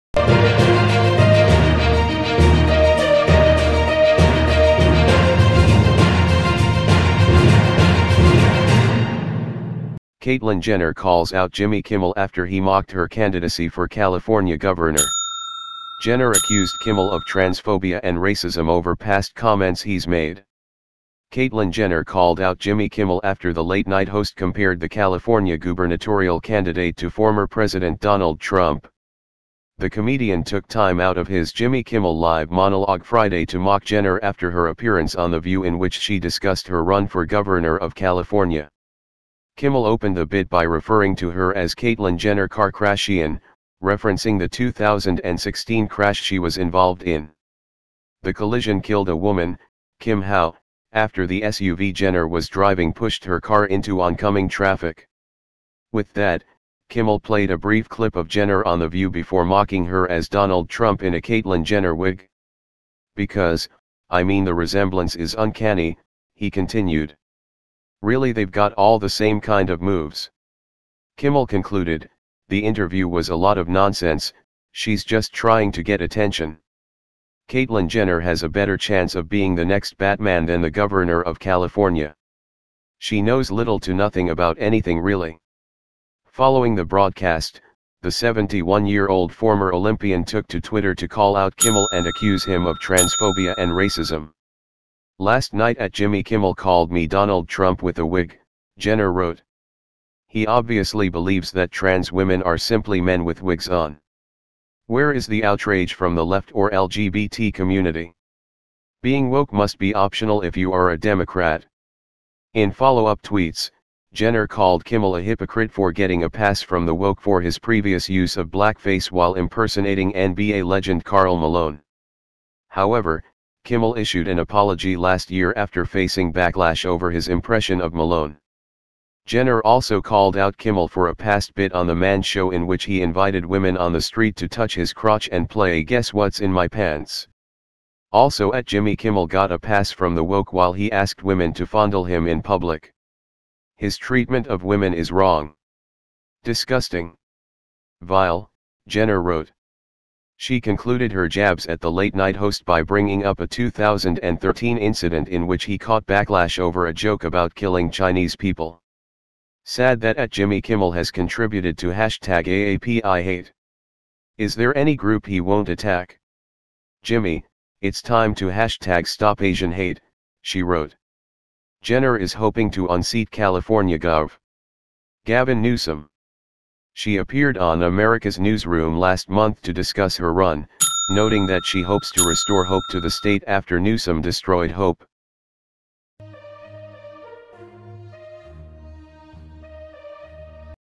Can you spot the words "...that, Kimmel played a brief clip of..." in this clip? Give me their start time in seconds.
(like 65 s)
56 s.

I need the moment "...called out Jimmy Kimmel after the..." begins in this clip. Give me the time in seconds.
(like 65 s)
22 s.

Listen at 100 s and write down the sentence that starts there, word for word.
He obviously believes that trans women are simply men with wigs on.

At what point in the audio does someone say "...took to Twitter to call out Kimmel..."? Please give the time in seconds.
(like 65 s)
90 s.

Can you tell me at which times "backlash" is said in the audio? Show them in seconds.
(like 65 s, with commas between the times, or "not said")
126 s, 156 s.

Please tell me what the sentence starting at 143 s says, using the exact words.
His treatment of women is wrong.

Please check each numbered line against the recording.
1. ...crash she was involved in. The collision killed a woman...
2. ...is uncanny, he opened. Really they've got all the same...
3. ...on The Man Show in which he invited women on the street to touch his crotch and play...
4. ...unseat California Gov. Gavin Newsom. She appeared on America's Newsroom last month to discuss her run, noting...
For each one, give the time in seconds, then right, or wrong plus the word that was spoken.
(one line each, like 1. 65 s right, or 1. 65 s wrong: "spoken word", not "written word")
1. 45 s right
2. 65 s wrong: "continued", not "opened"
3. 131 s right
4. 172 s right.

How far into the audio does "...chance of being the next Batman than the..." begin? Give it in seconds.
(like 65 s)
78 s.